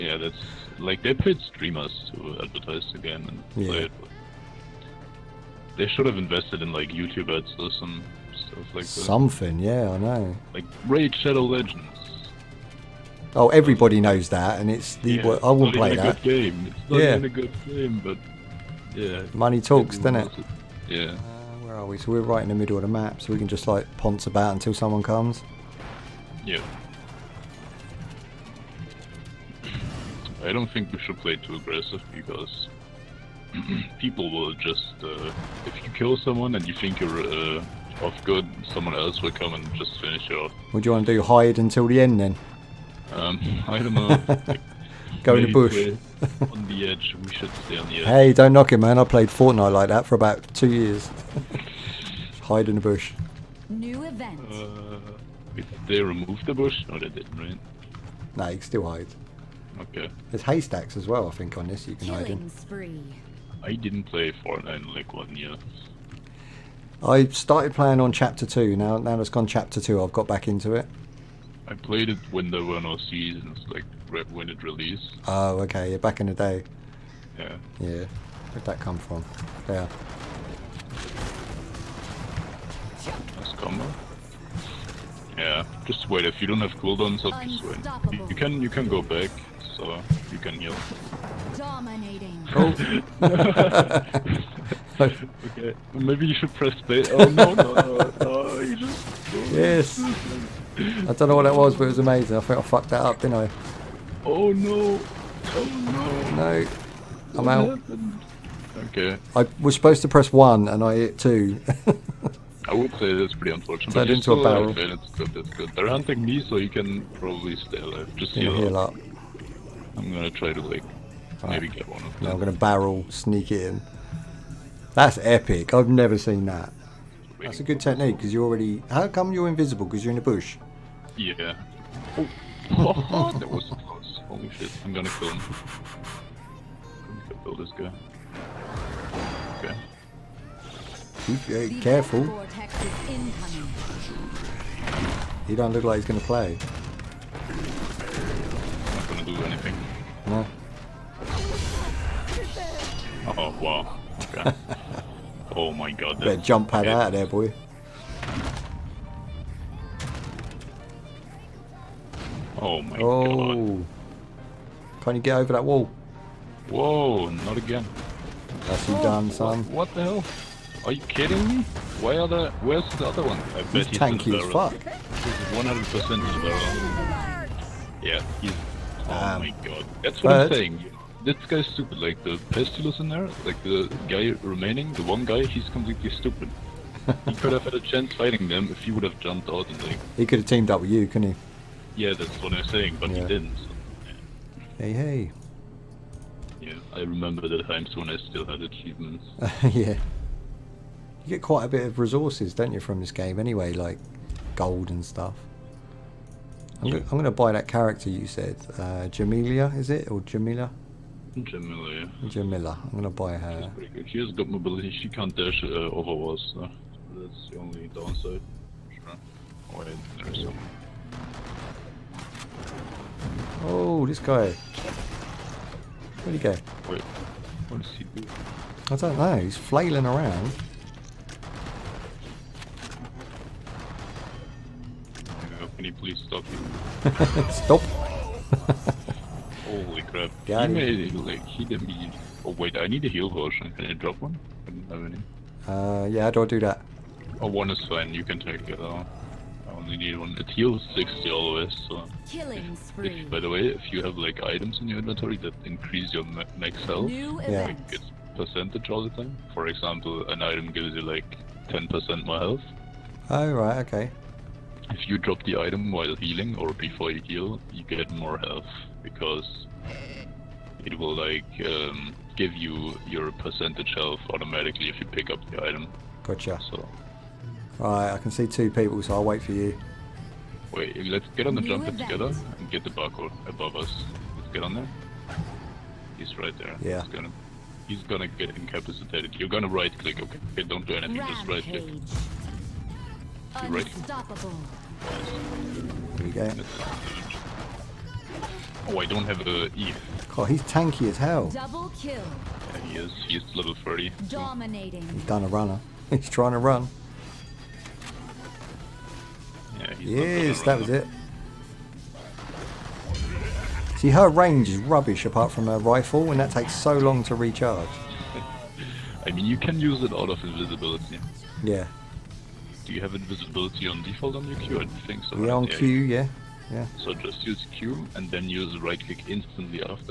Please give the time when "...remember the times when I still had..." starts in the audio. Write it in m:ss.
3:17.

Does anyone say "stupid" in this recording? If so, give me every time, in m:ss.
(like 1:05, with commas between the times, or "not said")
3:01, 3:06.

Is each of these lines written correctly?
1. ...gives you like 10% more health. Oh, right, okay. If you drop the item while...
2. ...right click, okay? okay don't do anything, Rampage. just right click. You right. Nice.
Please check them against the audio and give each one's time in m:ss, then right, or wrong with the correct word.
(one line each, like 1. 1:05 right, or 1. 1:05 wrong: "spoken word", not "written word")
1. 4:20 right
2. 4:49 right.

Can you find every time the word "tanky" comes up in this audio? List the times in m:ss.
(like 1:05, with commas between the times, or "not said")
2:53, 5:00.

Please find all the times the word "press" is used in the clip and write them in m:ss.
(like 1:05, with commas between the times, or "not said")
1:36, 1:50.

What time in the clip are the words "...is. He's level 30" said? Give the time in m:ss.
5:02.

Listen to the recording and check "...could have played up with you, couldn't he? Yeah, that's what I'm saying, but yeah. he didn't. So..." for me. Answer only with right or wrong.
wrong.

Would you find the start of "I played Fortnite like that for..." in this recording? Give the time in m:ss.
0:48.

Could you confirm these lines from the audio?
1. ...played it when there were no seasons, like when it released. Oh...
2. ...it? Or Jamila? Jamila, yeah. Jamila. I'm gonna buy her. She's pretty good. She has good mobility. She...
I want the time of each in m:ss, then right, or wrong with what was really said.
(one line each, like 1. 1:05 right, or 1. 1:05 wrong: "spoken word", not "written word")
1. 1:11 right
2. 3:29 right.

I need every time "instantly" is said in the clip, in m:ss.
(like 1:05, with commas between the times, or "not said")
5:29.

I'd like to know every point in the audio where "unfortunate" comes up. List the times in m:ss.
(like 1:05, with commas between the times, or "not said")
1:53.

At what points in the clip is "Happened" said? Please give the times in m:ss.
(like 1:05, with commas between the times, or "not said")
1:47.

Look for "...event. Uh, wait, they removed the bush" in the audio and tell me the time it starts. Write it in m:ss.
0:54.